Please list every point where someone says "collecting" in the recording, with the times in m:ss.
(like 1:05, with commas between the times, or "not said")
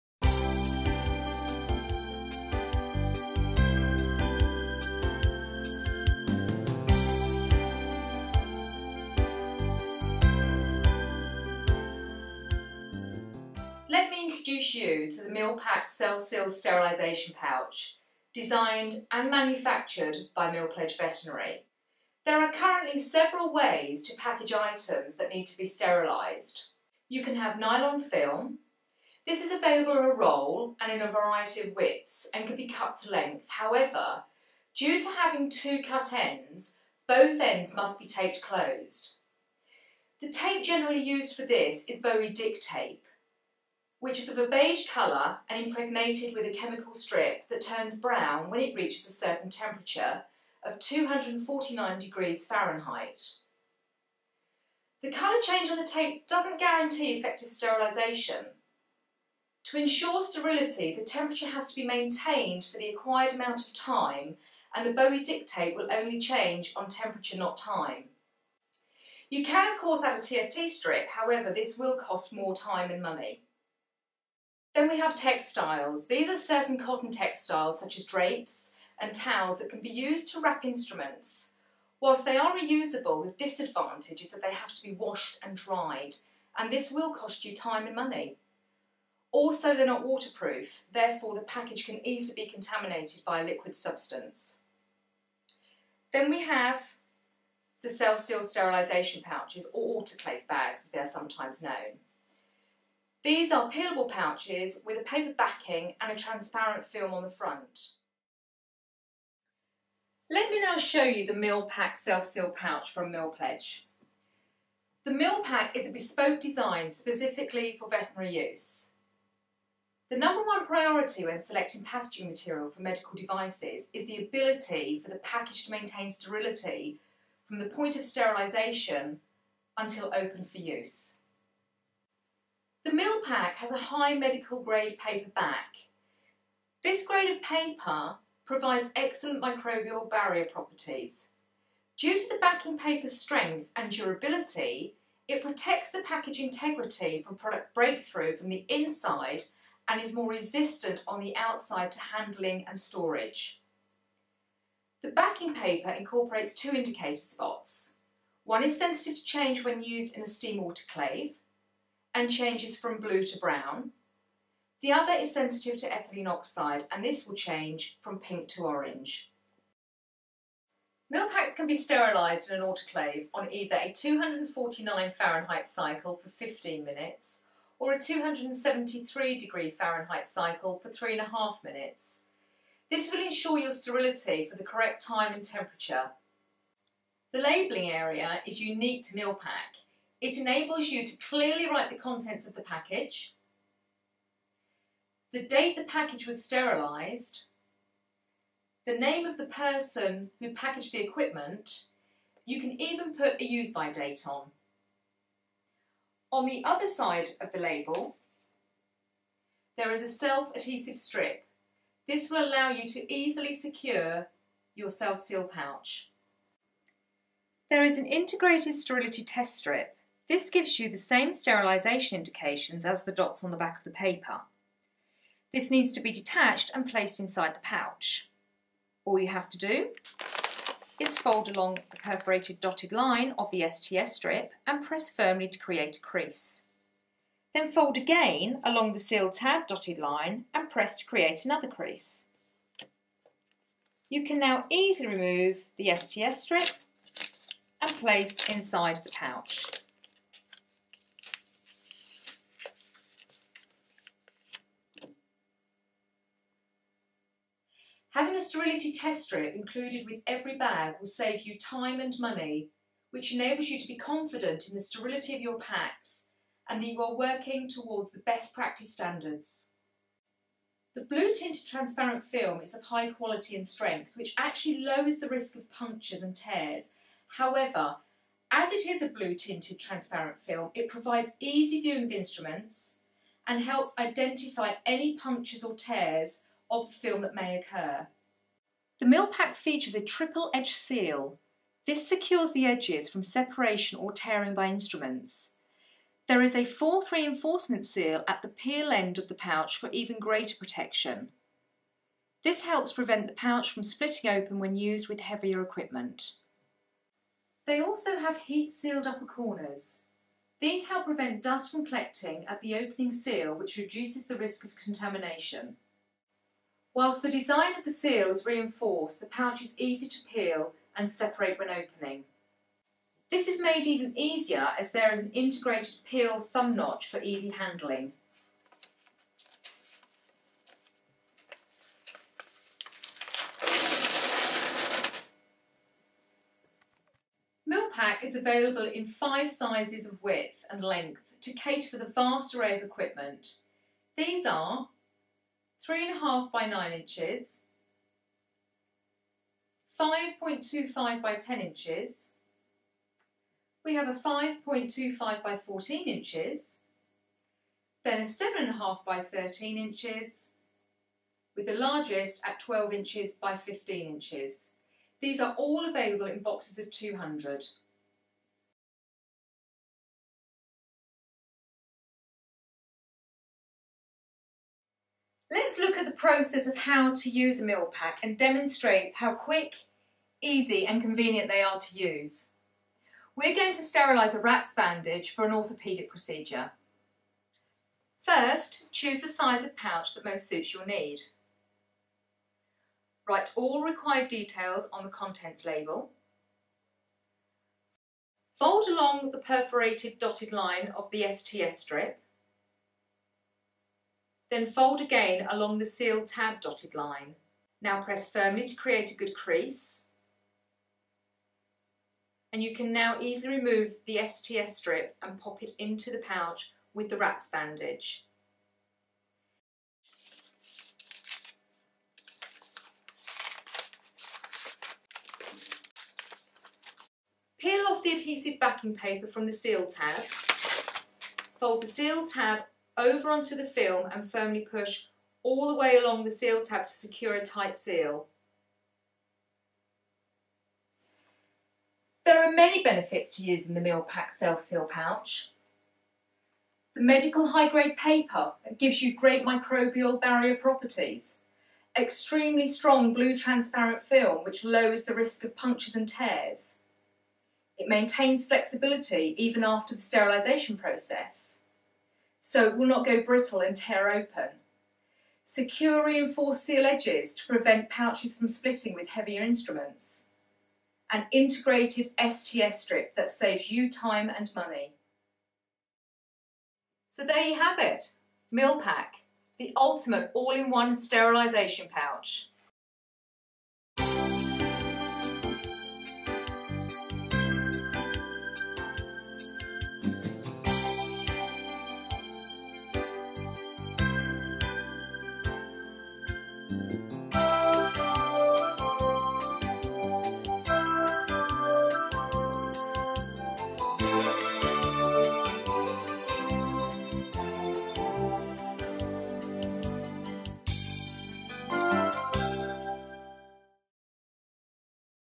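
5:11.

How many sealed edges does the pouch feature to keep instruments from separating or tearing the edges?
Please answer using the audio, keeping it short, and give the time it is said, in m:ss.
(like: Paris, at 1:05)
triple edge seal, at 4:50.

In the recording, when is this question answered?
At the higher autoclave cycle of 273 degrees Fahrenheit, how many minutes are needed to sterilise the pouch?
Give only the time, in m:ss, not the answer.
3:00.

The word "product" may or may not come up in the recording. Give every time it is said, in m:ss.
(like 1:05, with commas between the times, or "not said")
2:27.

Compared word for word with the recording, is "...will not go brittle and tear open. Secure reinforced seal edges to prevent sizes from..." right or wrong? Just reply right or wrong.
wrong.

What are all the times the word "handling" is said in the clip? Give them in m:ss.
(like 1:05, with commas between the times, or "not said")
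2:31, 5:27.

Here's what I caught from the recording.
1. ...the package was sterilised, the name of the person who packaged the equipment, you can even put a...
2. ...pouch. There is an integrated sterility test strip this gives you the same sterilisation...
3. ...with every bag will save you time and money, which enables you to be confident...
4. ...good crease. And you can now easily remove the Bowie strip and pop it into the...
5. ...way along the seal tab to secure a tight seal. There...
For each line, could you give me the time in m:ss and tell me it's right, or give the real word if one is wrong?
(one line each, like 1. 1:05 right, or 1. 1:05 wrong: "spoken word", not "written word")
1. 3:15 right
2. 3:35 right
3. 4:20 right
4. 6:49 wrong: "STS", not "Bowie"
5. 7:15 right.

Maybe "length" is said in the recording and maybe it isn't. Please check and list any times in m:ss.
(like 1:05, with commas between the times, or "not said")
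0:33, 5:40.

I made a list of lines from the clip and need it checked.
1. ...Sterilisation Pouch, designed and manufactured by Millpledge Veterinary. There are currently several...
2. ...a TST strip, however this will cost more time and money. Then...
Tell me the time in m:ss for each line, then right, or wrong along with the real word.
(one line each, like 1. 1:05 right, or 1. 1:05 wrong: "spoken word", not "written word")
1. 0:16 right
2. 1:10 right.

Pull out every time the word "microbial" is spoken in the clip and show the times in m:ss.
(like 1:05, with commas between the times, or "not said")
2:19, 7:29.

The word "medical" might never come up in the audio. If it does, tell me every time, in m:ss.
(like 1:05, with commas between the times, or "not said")
2:02, 2:14, 7:27.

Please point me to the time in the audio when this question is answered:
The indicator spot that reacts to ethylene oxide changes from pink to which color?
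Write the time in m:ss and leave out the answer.
2:48.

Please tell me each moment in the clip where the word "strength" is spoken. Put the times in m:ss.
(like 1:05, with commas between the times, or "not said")
2:23, 4:33.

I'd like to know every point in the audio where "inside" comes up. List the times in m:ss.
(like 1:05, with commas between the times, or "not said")
2:28, 3:47, 4:08.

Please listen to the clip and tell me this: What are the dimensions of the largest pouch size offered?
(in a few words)
12 by 15 inches.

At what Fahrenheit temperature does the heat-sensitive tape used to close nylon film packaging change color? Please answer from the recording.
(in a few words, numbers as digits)
249 degrees Fahrenheit.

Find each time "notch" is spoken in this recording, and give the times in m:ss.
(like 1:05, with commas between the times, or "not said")
5:26.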